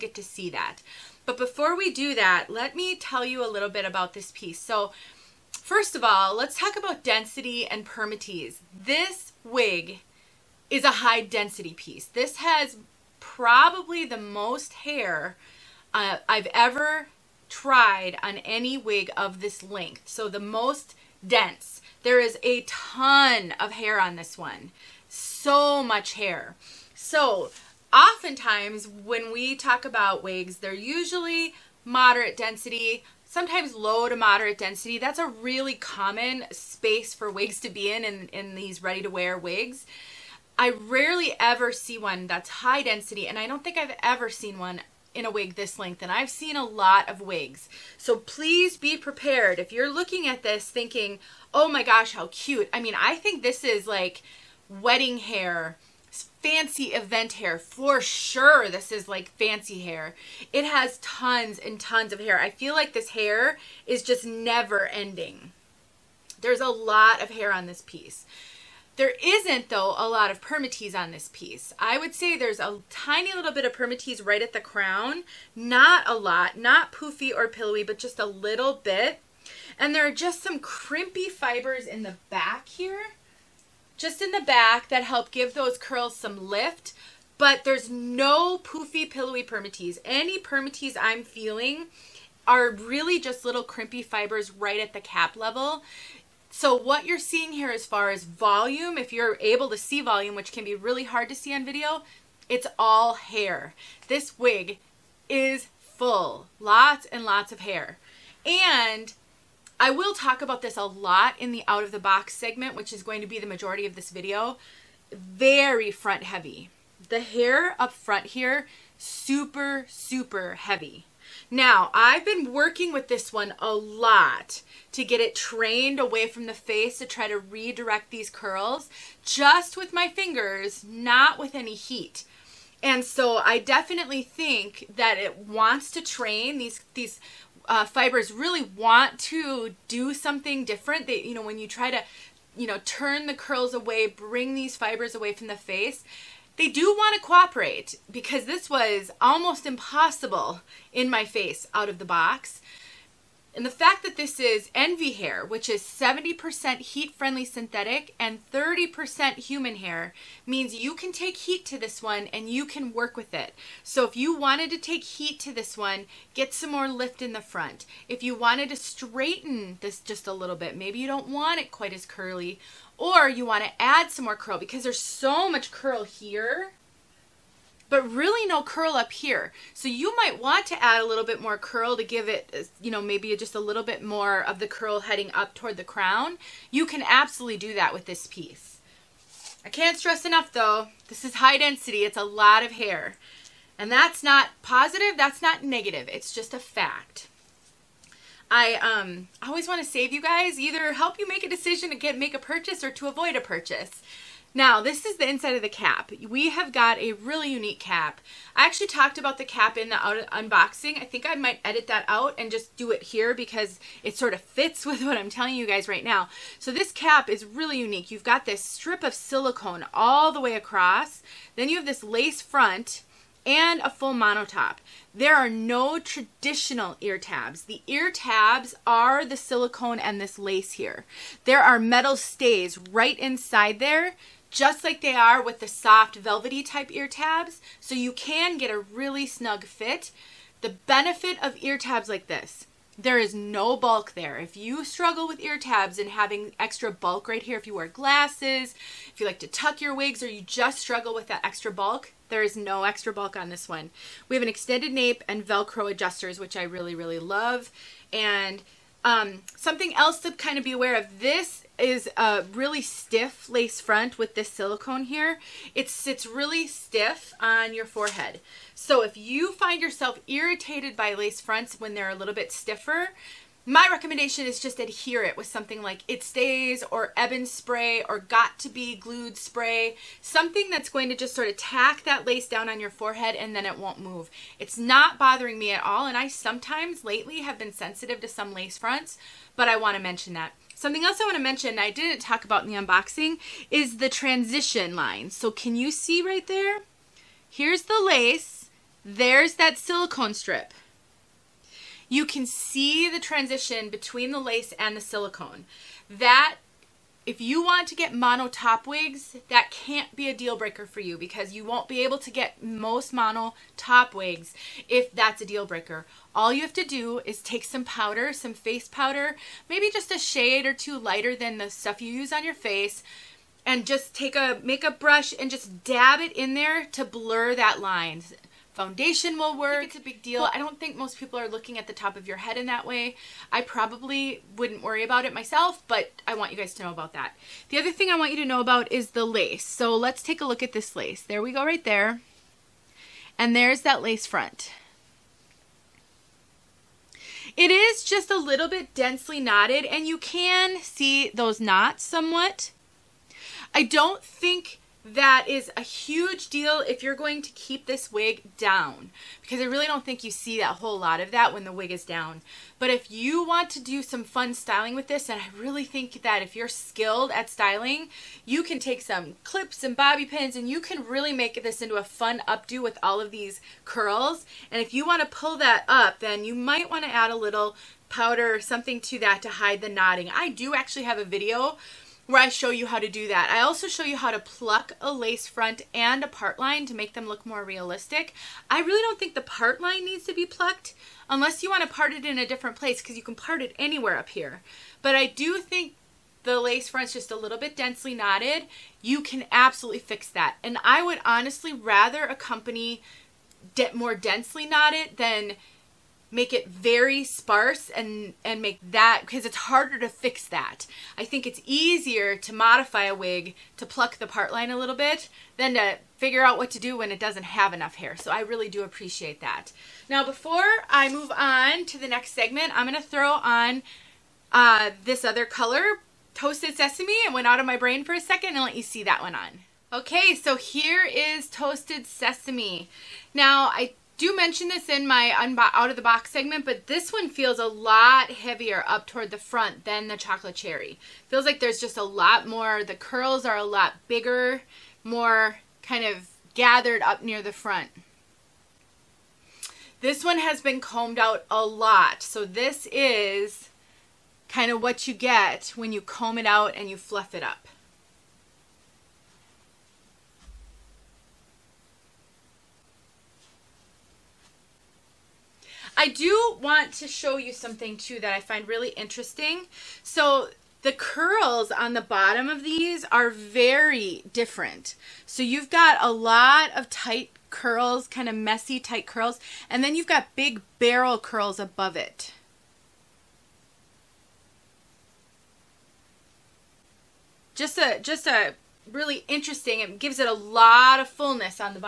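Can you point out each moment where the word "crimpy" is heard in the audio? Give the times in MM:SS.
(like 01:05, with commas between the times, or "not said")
01:20, 01:33.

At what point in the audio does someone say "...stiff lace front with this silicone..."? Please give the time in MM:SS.
04:22.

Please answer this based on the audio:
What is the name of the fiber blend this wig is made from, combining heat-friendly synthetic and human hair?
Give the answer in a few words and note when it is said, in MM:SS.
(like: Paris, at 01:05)
Envy hair, at 02:34.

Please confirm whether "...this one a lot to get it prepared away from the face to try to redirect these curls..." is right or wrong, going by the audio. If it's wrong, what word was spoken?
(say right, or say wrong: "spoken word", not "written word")
wrong: "trained", not "prepared".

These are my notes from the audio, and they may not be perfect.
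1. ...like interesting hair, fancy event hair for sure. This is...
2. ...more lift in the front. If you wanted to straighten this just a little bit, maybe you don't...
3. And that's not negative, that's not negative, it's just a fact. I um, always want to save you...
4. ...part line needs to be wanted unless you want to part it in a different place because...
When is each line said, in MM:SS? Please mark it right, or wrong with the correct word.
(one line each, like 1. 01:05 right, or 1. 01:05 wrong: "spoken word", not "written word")
1. 00:53 wrong: "wedding", not "interesting"
2. 02:46 right
3. 03:13 wrong: "positive", not "negative"
4. 06:29 wrong: "plucked", not "wanted".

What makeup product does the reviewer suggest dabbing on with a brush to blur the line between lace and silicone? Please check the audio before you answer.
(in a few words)
Face powder.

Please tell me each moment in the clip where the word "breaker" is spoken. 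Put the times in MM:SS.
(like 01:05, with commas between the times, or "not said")
05:10, 05:15.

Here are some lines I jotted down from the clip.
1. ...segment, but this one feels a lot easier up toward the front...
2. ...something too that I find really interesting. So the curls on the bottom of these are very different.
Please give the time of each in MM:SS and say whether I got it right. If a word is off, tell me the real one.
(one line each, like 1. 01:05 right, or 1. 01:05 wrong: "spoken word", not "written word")
1. 07:16 wrong: "heavier", not "easier"
2. 07:47 right.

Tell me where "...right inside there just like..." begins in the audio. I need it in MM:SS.
03:52.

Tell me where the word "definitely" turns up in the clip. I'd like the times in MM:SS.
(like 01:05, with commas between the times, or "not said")
02:13.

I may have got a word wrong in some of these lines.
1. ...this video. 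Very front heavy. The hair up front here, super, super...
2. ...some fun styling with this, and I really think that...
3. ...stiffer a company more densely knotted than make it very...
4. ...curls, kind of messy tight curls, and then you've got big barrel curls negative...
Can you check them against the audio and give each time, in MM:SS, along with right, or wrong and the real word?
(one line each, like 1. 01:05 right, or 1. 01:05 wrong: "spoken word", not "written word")
1. 01:53 right
2. 06:04 right
3. 06:41 wrong: "rather", not "stiffer"
4. 07:57 wrong: "above", not "negative".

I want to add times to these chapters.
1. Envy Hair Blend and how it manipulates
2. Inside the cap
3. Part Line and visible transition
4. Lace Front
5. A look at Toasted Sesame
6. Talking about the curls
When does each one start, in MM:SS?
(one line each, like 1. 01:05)
1. 02:35
2. 03:23
3. 04:53
4. 05:39
5. 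07:10
6. 07:51.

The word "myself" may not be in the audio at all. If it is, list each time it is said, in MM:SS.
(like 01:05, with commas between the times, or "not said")
05:35.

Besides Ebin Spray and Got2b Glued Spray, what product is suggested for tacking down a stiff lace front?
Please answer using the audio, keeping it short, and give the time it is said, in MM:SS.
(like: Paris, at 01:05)
It Stays, at 04:36.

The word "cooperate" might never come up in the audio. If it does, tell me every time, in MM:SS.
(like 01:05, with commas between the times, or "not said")
02:27.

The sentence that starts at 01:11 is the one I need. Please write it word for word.
I would say there's a tiny little bit of permatease right at the crown.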